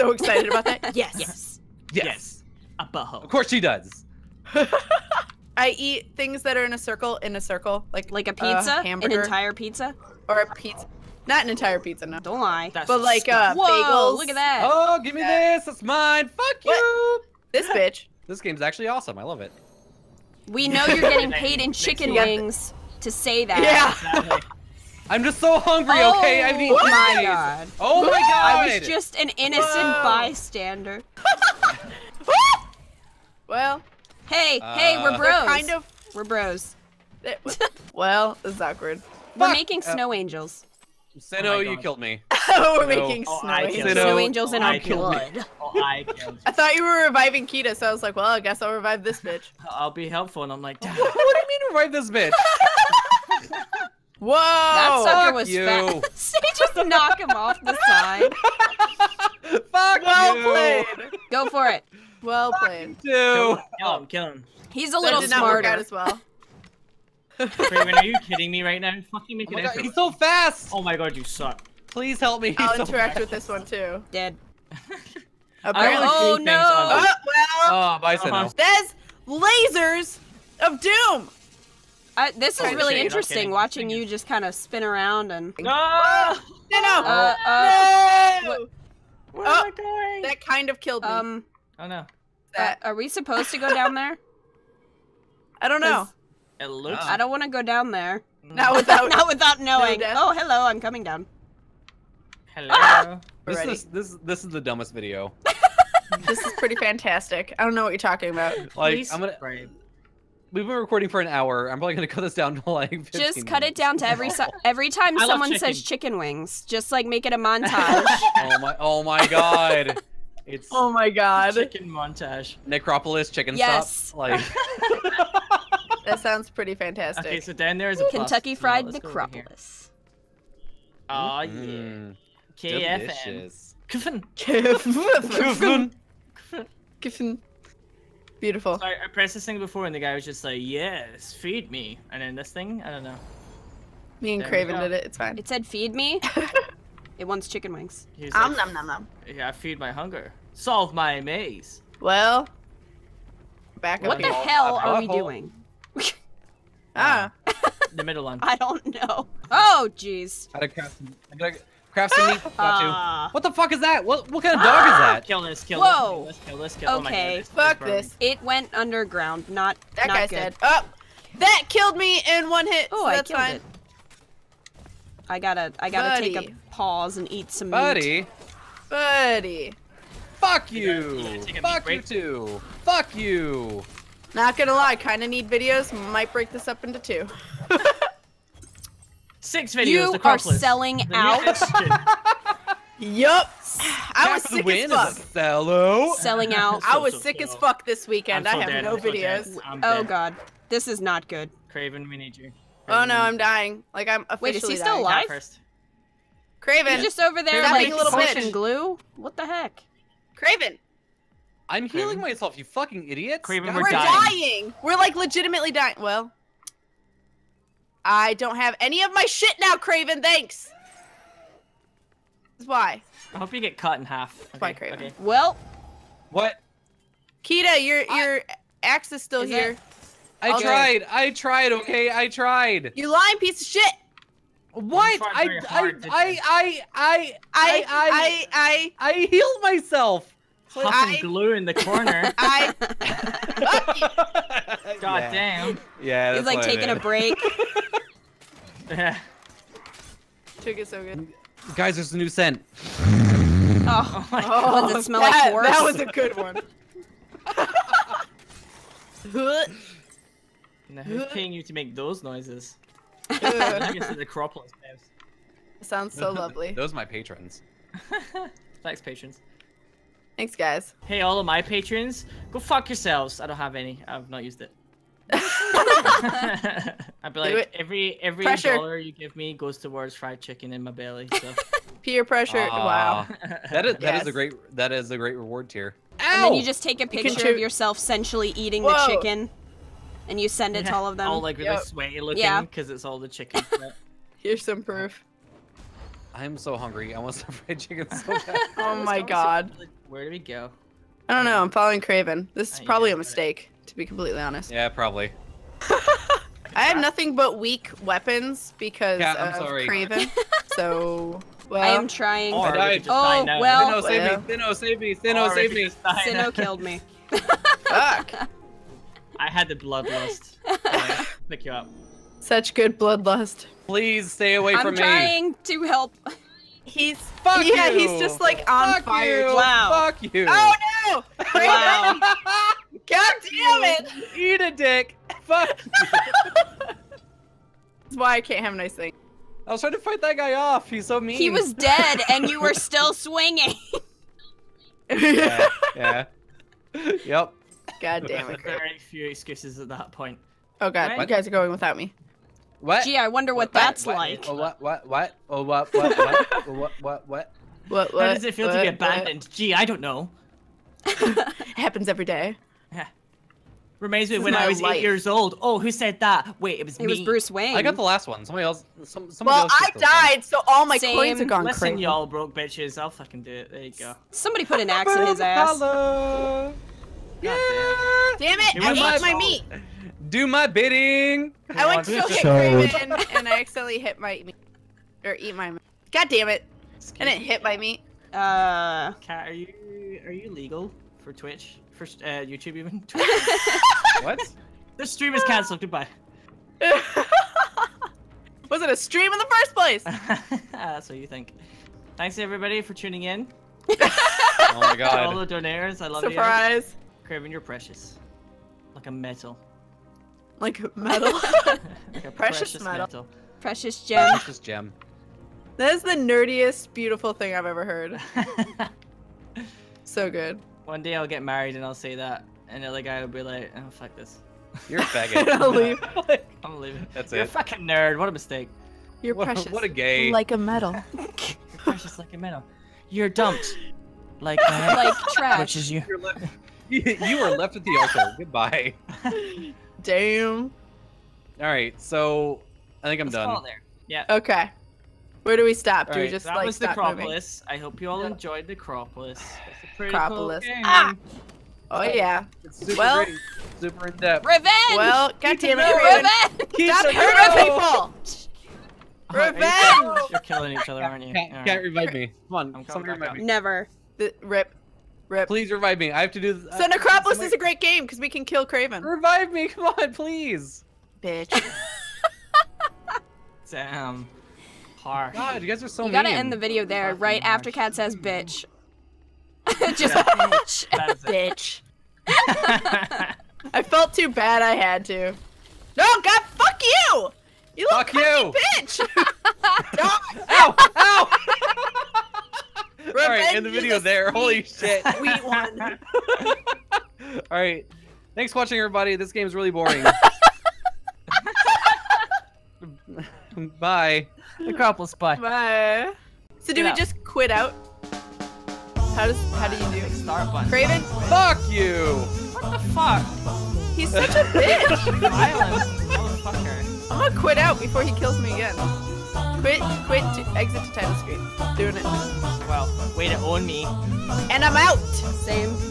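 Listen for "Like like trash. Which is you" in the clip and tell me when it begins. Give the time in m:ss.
7:14.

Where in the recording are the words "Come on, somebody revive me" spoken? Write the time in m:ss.
7:42.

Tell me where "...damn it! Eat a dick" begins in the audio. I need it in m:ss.
5:33.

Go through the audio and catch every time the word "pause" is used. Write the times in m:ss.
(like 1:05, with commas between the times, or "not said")
2:56.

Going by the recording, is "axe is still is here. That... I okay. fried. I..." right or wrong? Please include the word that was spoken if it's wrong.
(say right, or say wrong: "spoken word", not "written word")
wrong: "tried", not "fried".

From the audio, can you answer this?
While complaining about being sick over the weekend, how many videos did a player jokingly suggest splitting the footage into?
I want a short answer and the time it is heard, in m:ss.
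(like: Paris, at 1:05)
Six, at 3:09.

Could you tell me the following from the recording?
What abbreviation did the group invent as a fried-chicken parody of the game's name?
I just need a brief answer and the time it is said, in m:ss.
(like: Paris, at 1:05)
KFN, at 2:12.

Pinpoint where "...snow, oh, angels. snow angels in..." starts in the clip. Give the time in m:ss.
0:43.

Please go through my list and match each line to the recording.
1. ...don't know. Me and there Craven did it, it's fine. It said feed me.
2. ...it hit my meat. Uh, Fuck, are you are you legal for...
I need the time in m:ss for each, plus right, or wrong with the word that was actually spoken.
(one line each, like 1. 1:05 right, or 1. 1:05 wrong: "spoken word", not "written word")
1. 2:22 right
2. 6:27 wrong: "Cat", not "Fuck".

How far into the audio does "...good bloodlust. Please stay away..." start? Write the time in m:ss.
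5:22.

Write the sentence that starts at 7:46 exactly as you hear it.
So Necropolis is a great game because we can kill Kravin.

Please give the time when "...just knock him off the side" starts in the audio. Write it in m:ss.
0:56.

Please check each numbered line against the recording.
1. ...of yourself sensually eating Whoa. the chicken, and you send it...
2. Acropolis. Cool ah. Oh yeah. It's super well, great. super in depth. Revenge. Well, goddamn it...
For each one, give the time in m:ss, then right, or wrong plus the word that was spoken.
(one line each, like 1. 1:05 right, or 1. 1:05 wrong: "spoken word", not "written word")
1. 4:47 right
2. 7:29 right.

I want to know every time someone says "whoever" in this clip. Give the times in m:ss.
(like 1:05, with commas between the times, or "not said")
not said.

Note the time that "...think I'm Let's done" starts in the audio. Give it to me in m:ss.
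7:23.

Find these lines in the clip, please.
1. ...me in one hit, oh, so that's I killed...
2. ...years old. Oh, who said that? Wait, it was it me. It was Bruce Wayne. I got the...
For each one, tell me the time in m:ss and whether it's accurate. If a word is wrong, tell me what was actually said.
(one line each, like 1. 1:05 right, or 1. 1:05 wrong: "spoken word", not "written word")
1. 2:51 right
2. 6:05 right.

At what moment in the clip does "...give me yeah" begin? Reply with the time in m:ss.
0:15.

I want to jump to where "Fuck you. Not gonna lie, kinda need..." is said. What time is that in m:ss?
3:02.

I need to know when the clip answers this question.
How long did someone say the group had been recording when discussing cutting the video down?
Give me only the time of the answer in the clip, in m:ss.
1:51.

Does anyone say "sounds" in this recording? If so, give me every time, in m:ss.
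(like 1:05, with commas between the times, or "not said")
2:06, 4:25.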